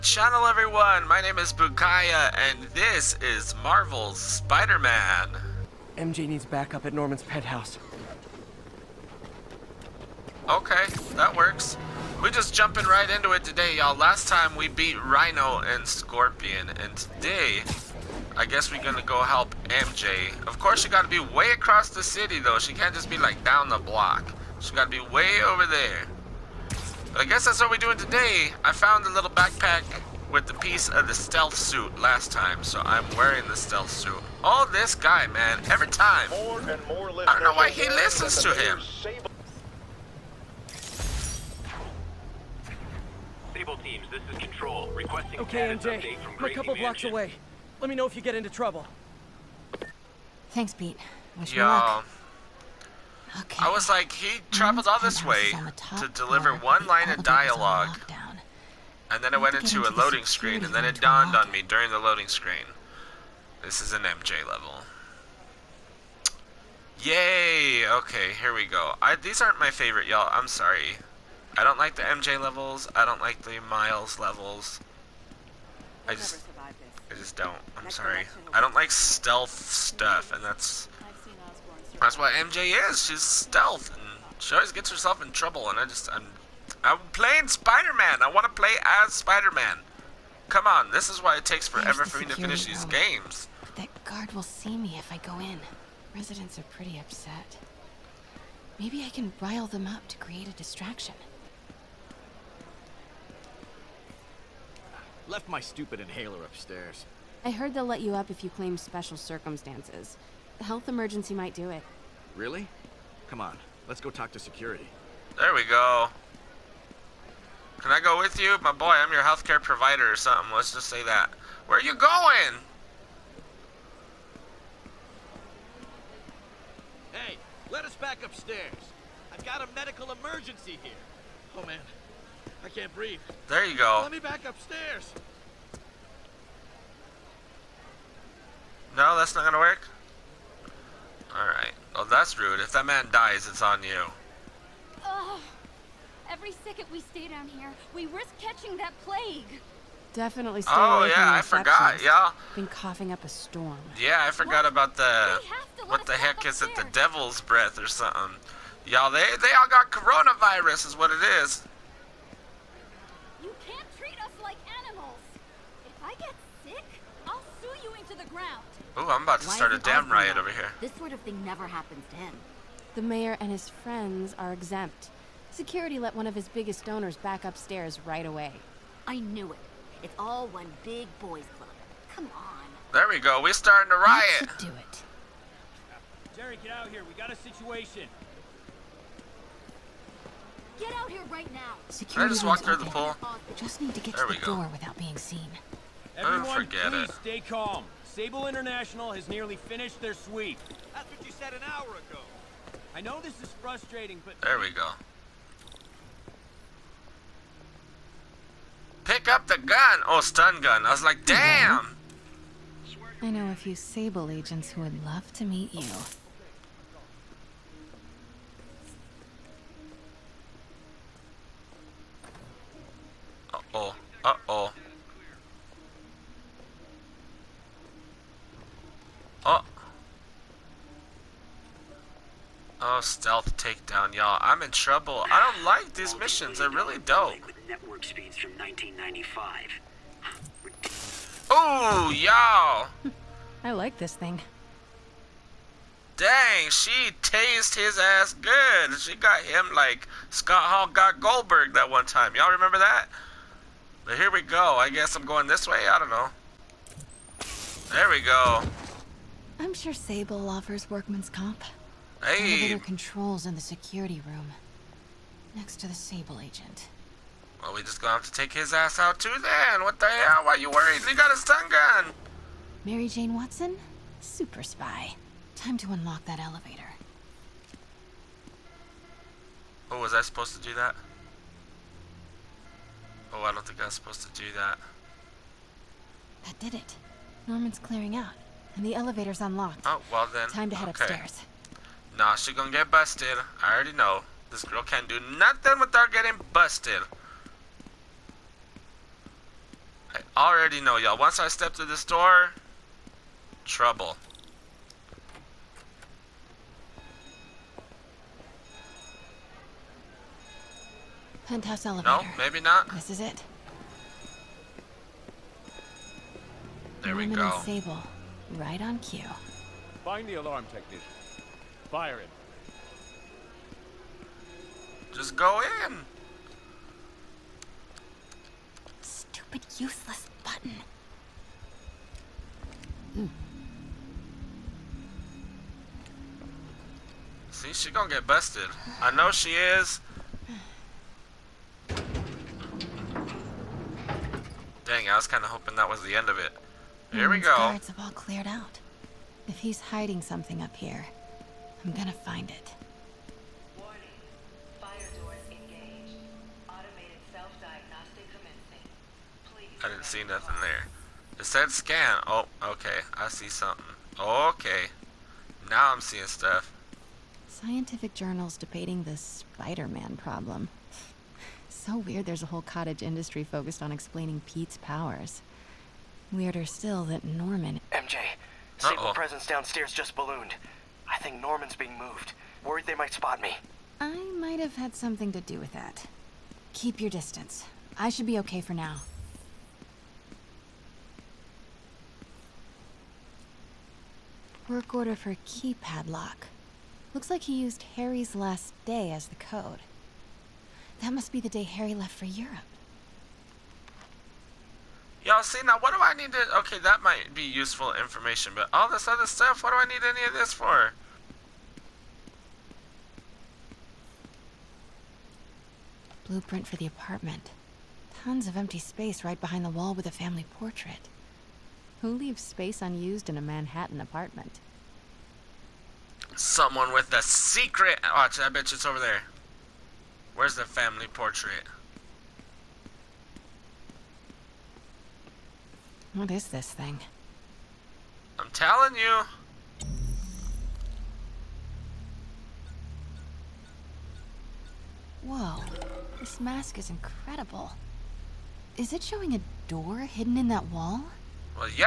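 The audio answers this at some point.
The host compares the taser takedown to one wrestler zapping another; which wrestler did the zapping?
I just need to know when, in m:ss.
4:10.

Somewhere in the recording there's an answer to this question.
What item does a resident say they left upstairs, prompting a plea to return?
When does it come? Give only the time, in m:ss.
1:45.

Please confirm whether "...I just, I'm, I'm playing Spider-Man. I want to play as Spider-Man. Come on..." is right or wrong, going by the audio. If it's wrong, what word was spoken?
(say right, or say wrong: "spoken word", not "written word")
right.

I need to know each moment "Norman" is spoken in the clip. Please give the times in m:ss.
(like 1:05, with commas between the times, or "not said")
0:06, 4:47, 5:17, 6:17, 6:21.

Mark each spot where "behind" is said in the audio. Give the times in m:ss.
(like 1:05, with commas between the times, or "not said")
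6:59.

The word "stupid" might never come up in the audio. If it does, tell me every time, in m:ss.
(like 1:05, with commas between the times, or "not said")
1:45, 5:28.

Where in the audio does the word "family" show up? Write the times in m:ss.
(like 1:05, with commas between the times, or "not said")
7:00, 7:10.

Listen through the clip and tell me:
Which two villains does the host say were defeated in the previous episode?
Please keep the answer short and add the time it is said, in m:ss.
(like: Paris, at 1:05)
Rhino and Scorpion, at 0:15.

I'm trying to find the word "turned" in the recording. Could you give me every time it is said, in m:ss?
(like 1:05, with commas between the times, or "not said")
not said.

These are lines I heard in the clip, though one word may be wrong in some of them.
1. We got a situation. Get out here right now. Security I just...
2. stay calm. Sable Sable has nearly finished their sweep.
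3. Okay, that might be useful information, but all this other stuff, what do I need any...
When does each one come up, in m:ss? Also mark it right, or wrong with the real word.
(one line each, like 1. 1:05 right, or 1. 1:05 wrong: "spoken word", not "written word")
1. 3:07 right
2. 3:17 wrong: "International", not "Sable"
3. 6:46 right.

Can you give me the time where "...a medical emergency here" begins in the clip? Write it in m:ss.
2:09.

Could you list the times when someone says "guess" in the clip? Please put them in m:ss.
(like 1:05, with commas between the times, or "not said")
0:18, 0:27, 4:14.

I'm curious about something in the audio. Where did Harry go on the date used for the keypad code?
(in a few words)
Europe.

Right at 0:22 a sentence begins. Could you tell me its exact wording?
She can't just be, like, down the block.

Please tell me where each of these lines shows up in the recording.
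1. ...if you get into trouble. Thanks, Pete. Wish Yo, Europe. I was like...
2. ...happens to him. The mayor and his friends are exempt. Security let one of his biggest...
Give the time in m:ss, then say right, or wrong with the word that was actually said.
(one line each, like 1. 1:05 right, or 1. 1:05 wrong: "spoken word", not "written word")
1. 0:48 wrong: "Okay", not "Europe"
2. 2:51 right.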